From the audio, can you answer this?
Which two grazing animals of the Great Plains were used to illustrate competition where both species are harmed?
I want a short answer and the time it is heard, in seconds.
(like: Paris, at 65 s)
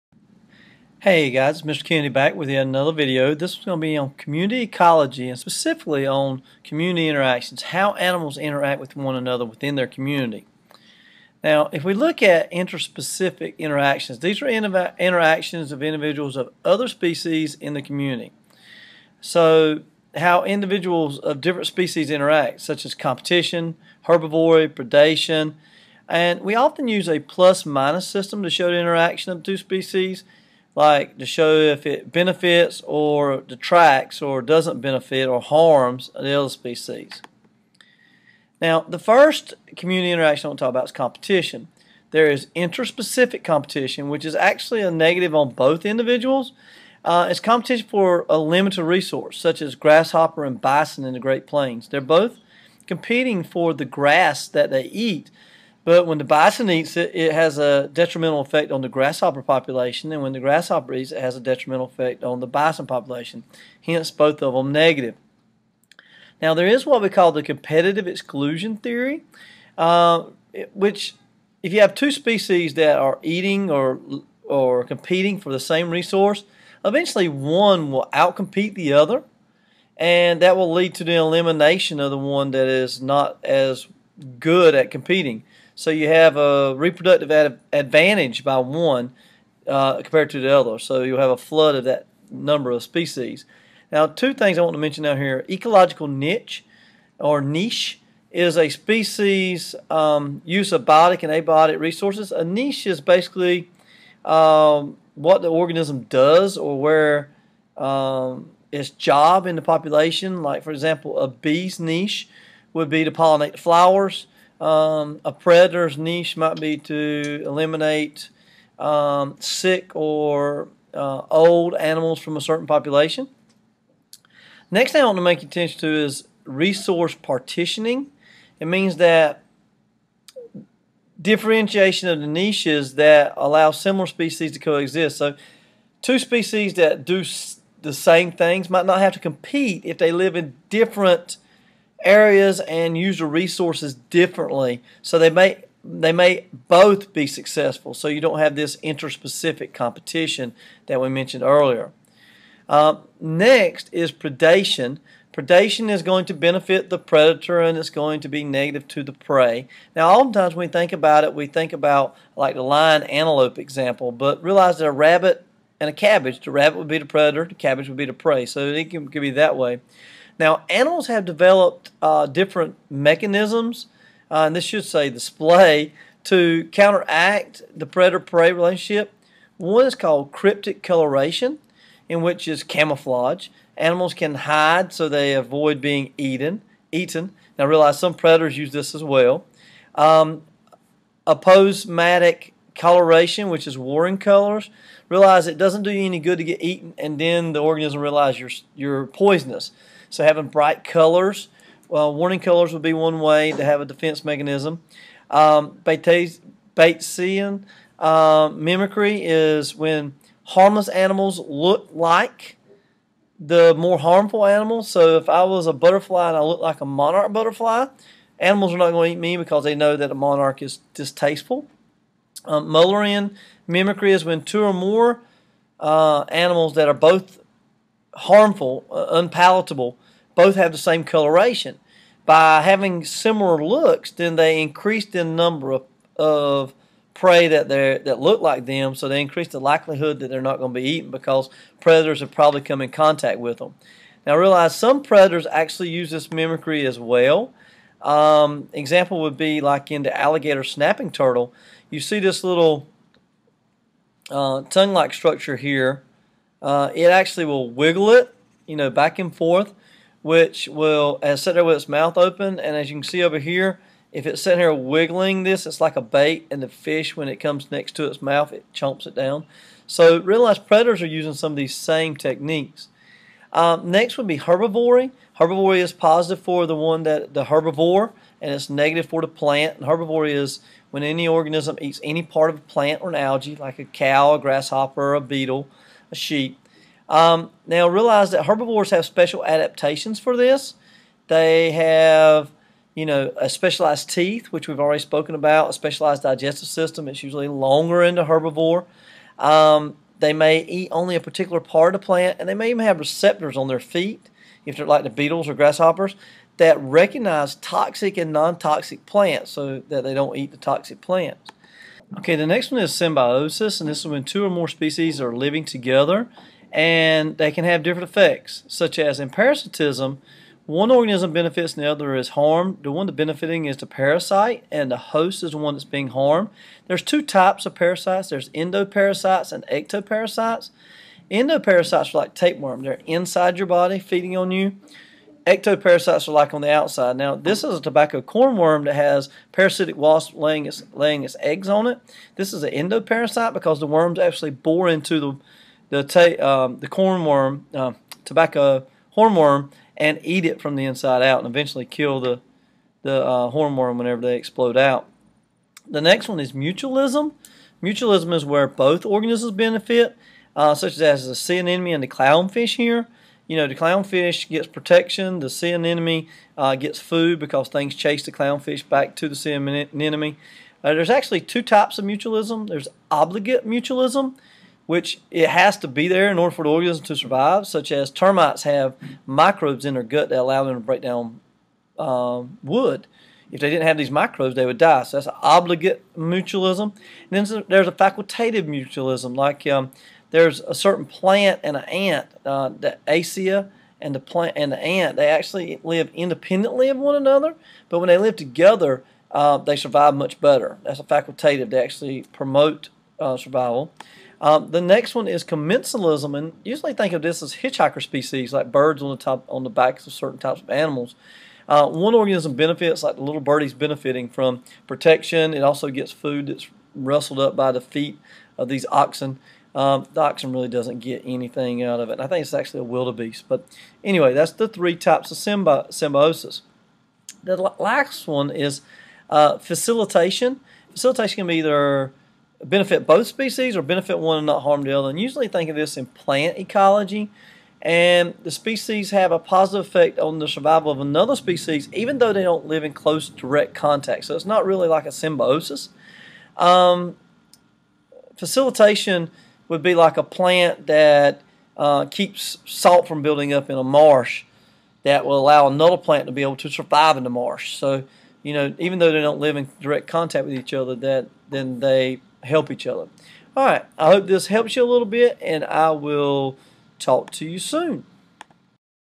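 grasshopper and bison, at 49 s.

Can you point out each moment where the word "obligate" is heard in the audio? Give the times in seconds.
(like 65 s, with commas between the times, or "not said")
373 s, 385 s.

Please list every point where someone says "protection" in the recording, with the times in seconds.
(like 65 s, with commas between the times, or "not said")
364 s, 414 s.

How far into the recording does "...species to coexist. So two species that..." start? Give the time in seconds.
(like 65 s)
134 s.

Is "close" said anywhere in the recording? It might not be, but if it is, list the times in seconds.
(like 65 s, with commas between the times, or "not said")
442 s.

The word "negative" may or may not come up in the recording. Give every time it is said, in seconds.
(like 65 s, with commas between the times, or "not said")
44 s, 64 s, 158 s, 278 s.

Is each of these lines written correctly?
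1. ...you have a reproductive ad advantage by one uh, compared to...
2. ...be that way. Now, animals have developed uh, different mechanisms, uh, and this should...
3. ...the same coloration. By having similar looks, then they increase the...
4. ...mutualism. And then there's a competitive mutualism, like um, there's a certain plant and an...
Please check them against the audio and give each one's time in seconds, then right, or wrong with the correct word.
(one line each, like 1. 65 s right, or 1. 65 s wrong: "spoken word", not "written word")
1. 85 s right
2. 169 s right
3. 230 s right
4. 386 s wrong: "facultative", not "competitive".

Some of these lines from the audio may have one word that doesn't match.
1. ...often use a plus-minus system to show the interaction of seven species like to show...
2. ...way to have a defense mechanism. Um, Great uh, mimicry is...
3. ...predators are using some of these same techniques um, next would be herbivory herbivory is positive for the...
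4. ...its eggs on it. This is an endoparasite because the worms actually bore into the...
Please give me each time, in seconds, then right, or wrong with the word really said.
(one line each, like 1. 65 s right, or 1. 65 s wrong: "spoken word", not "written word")
1. 26 s wrong: "two", not "seven"
2. 203 s wrong: "Batesian", not "Great"
3. 270 s right
4. 341 s right.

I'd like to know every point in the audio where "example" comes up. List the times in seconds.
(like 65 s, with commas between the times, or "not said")
110 s, 163 s, 248 s.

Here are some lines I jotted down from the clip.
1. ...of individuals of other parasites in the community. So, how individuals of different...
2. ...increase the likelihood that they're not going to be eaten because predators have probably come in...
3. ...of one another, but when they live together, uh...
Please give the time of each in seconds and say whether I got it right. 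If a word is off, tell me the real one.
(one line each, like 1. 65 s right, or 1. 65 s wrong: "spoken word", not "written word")
1. 15 s wrong: "species", not "parasites"
2. 239 s right
3. 396 s right.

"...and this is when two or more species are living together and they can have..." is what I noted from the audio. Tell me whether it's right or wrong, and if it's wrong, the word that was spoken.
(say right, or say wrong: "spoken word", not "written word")
right.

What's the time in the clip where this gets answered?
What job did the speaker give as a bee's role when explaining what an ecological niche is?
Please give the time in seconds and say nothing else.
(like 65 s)
113 s.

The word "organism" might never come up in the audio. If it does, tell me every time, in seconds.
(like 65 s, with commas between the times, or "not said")
105 s, 197 s, 281 s, 320 s, 359 s, 376 s, 412 s.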